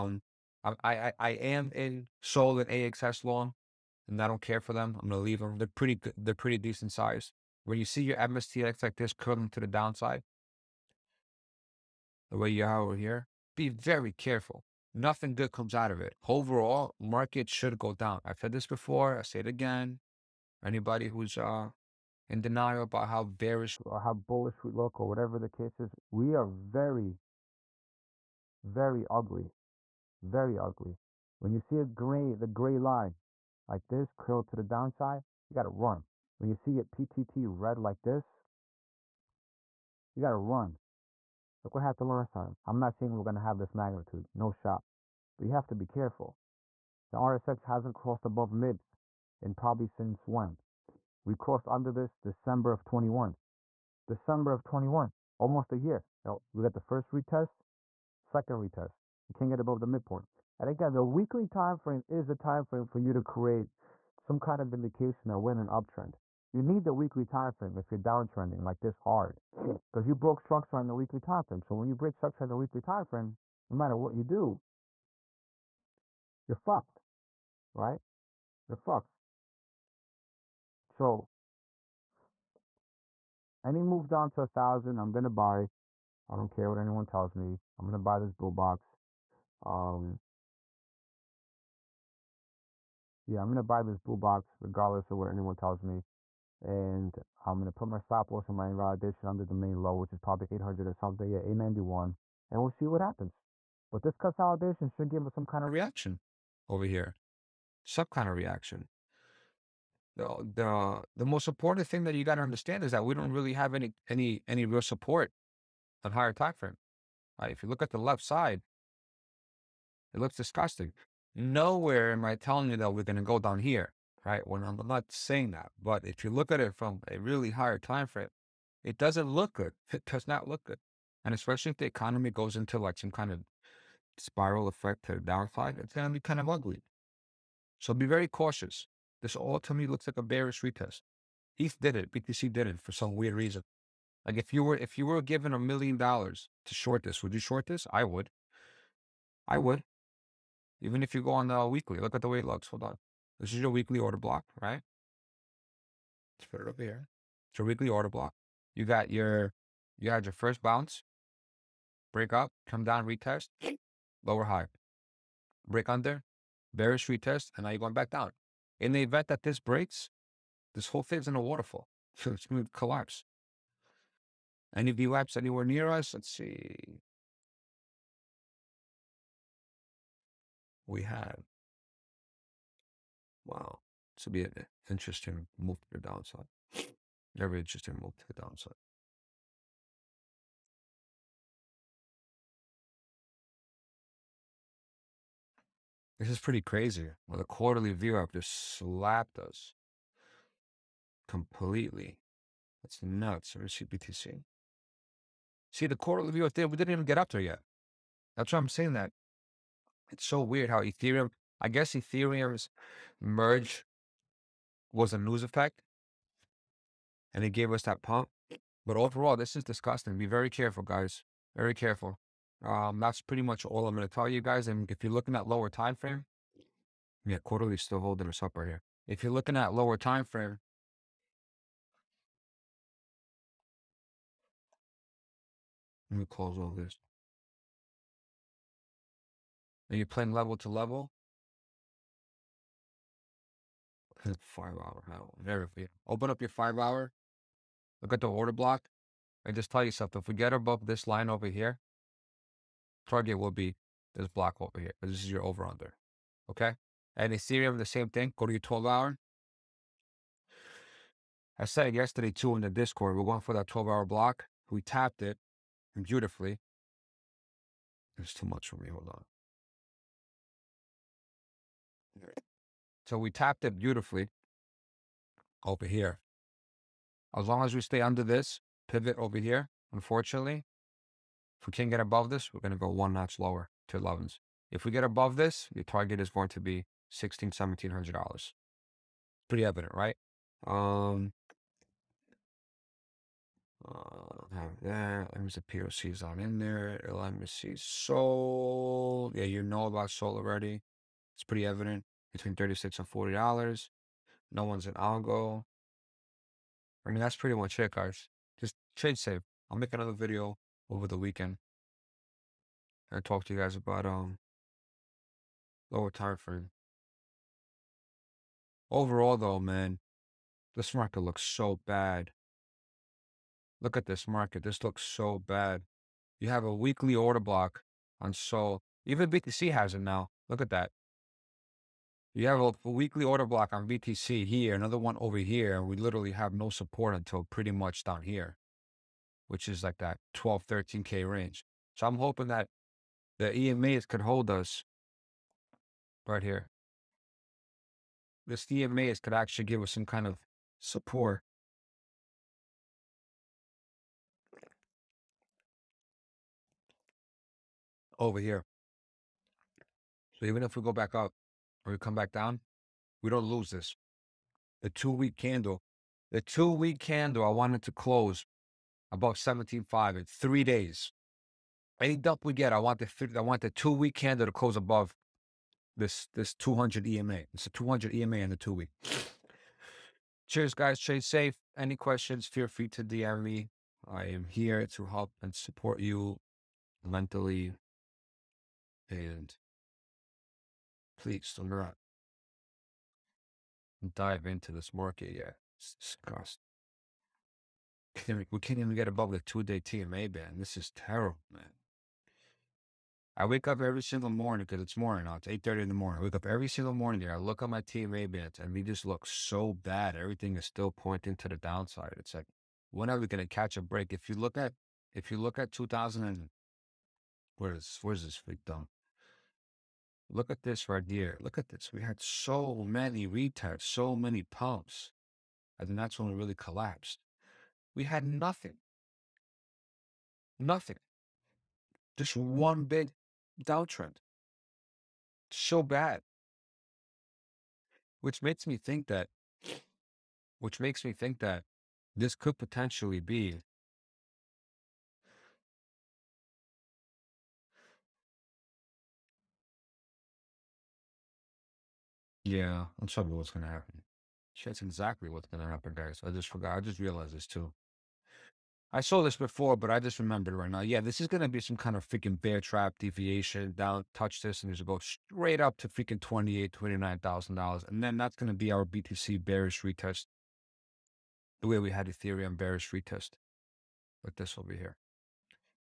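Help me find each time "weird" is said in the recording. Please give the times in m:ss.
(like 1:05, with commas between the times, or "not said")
2:23, 3:30.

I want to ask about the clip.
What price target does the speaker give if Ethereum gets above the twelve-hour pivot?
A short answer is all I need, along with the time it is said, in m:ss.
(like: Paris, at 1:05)
$1,600-1,700, at 4:47.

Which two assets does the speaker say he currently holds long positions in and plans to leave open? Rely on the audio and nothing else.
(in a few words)
SOL and AXS.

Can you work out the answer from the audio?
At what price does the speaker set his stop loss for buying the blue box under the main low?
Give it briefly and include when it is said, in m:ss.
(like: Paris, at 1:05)
891, at 1:41.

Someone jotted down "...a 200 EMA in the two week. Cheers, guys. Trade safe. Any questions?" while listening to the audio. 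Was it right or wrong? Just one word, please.
right.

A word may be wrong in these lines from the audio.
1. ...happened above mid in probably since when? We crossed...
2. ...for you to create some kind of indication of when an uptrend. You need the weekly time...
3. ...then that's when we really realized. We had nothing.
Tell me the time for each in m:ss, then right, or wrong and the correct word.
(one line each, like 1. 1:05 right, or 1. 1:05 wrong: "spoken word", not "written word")
1. 0:47 wrong: "crossed", not "happened"
2. 1:02 right
3. 7:05 wrong: "collapsed", not "realized".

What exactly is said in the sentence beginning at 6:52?
It's like, when are we going to catch a break?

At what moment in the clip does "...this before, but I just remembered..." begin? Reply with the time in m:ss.
7:39.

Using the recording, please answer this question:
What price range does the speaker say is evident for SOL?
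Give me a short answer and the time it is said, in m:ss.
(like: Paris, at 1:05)
$36 to $40, at 5:02.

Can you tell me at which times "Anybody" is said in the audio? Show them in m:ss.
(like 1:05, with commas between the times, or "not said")
0:20.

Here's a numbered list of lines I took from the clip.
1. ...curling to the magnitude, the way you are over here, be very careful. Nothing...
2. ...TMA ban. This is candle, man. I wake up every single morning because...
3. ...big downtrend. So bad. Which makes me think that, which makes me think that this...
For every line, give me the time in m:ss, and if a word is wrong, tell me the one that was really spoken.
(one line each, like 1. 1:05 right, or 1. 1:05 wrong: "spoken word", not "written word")
1. 0:09 wrong: "downside", not "magnitude"
2. 6:39 wrong: "terrible", not "candle"
3. 7:12 right.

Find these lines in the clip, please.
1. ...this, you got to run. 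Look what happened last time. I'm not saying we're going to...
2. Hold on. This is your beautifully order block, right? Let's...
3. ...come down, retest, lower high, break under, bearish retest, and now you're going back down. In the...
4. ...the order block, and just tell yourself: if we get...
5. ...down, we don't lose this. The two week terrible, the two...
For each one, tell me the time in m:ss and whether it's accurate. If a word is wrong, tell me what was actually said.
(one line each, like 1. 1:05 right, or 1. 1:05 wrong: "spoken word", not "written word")
1. 0:38 right
2. 2:32 wrong: "weekly", not "beautifully"
3. 2:42 right
4. 4:08 right
5. 6:02 wrong: "candle", not "terrible".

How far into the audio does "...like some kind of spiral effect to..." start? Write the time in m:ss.
2:12.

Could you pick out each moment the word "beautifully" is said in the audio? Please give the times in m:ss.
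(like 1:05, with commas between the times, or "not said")
4:26, 4:33.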